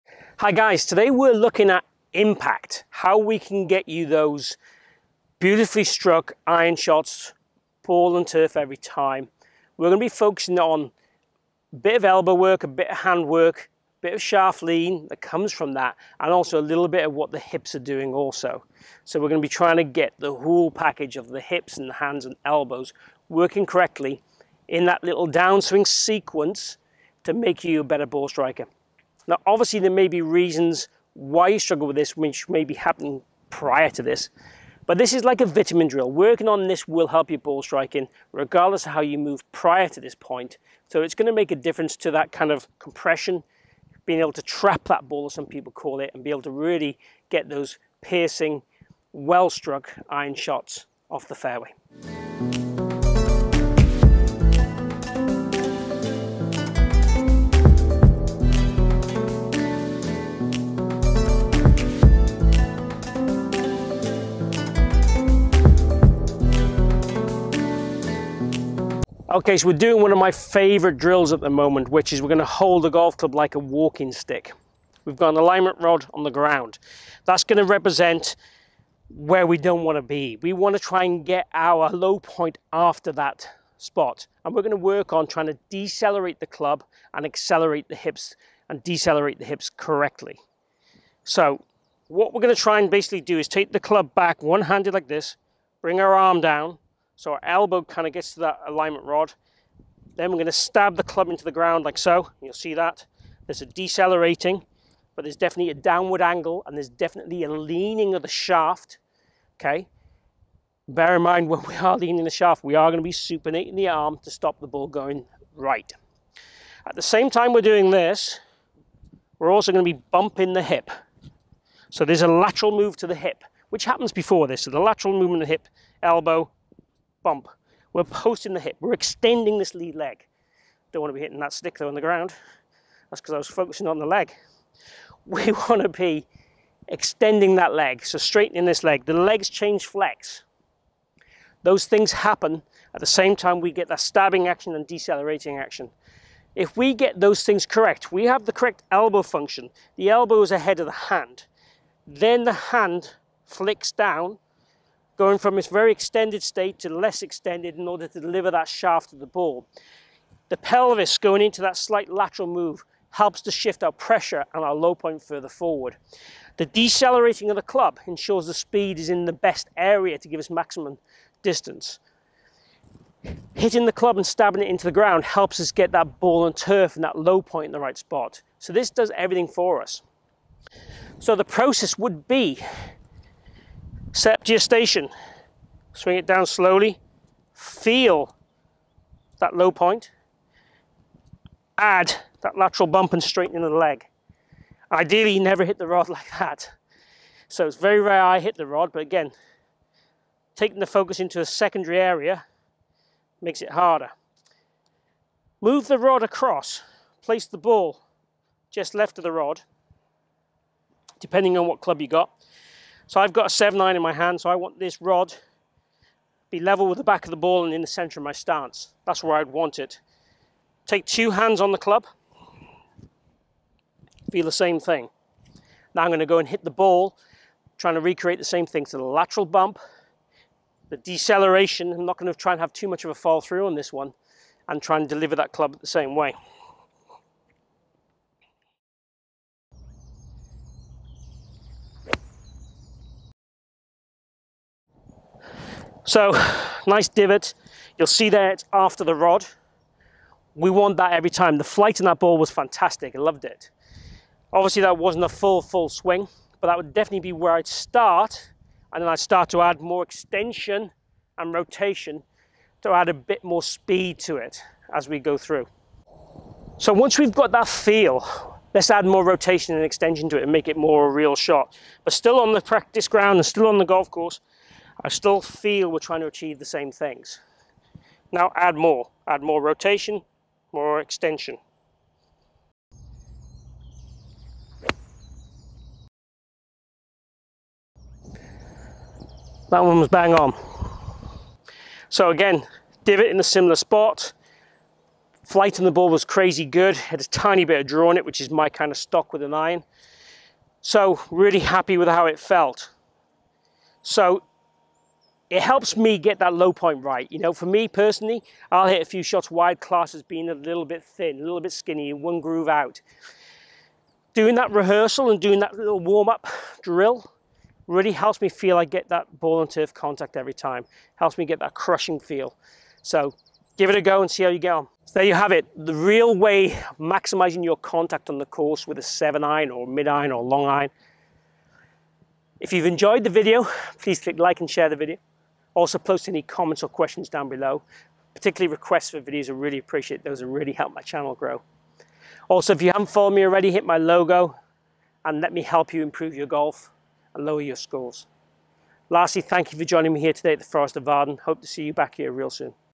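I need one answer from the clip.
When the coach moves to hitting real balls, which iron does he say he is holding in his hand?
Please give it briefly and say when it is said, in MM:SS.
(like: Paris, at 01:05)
7-9, at 03:33.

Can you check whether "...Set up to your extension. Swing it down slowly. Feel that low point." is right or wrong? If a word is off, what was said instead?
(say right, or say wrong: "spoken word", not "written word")
wrong: "station", not "extension".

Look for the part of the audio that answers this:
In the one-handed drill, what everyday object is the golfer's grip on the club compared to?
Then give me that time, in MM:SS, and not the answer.
01:13.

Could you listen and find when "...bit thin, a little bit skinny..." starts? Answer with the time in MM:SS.
05:10.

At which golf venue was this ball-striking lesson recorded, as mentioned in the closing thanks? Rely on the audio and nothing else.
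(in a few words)
Forest of Arden.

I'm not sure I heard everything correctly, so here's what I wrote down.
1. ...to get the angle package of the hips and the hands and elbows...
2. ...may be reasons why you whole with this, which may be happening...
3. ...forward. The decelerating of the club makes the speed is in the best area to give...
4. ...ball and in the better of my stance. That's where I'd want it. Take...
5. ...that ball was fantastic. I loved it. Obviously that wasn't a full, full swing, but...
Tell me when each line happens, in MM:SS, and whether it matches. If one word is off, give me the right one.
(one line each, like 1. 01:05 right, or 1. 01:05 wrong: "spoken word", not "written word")
1. 00:19 wrong: "whole", not "angle"
2. 00:29 wrong: "struggle", not "whole"
3. 02:45 wrong: "ensures", not "makes"
4. 03:37 wrong: "center", not "better"
5. 04:12 right.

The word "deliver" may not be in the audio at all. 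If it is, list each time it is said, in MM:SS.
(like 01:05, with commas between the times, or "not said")
02:38, 03:55.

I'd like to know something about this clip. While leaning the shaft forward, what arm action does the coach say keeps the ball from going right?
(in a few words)
supinating.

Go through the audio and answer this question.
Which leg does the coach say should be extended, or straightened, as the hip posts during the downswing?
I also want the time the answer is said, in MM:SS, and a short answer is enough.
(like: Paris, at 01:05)
lead leg, at 02:09.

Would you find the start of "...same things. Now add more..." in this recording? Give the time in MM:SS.
04:36.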